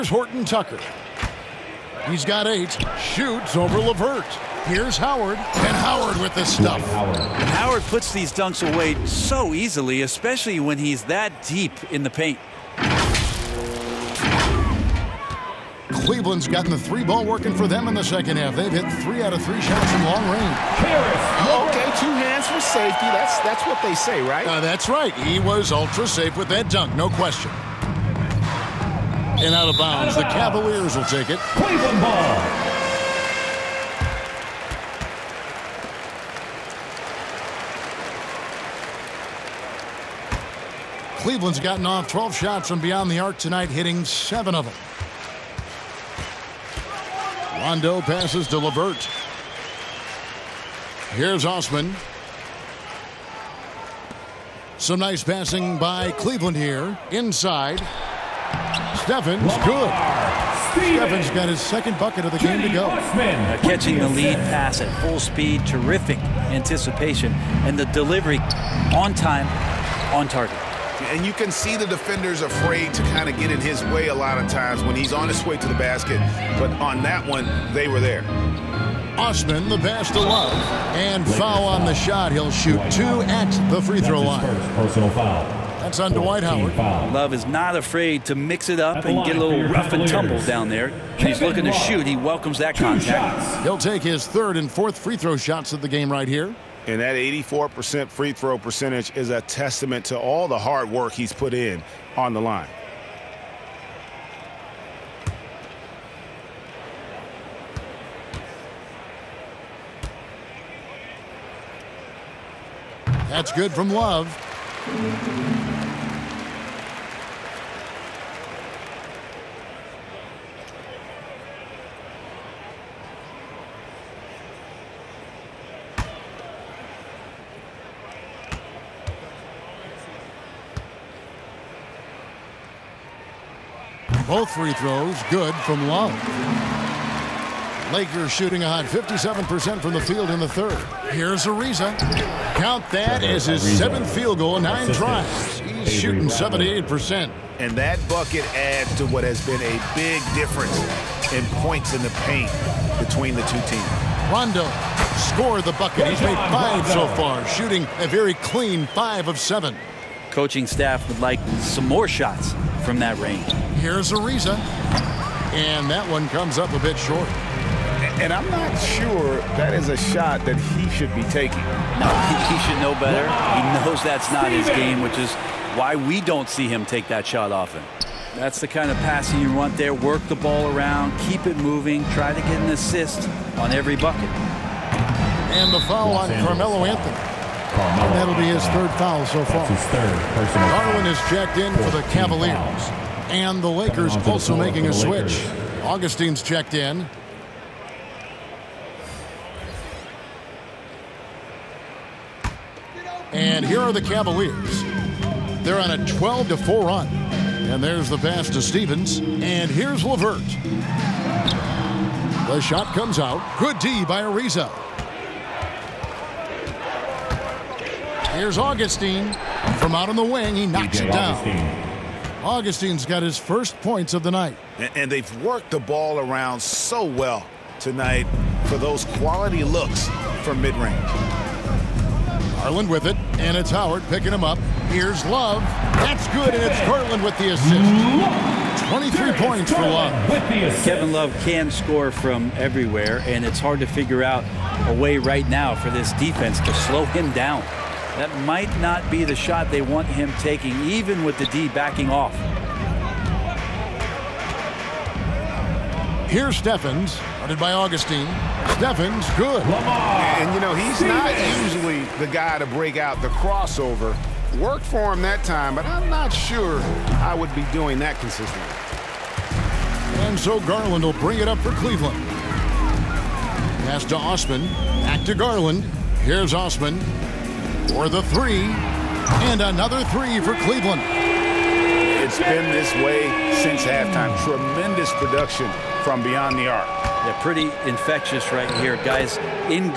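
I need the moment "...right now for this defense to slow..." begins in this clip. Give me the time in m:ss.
4:05.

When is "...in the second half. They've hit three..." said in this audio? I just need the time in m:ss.
0:17.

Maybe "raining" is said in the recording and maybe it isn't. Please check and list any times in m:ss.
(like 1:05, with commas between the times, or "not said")
not said.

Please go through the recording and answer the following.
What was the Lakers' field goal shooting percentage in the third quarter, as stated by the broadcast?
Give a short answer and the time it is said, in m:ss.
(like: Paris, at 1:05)
57%, at 2:18.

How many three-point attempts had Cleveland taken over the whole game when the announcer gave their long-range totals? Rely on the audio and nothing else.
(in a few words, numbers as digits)
12.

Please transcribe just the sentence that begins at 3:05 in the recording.
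And the foul on Carmelo Anthony.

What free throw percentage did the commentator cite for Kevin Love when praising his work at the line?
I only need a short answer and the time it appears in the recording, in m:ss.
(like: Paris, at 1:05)
84%, at 1:37.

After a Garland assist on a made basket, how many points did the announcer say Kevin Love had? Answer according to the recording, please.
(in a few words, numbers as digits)
23.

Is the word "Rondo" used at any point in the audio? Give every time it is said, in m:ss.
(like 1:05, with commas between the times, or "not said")
0:47, 2:34.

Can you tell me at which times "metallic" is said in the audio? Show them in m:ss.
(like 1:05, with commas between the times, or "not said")
not said.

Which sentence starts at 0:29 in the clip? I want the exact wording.
And out of bounds, out of bounds.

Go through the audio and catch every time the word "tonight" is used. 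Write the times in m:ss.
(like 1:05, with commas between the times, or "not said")
0:43, 3:47.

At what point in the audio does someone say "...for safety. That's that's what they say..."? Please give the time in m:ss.
0:22.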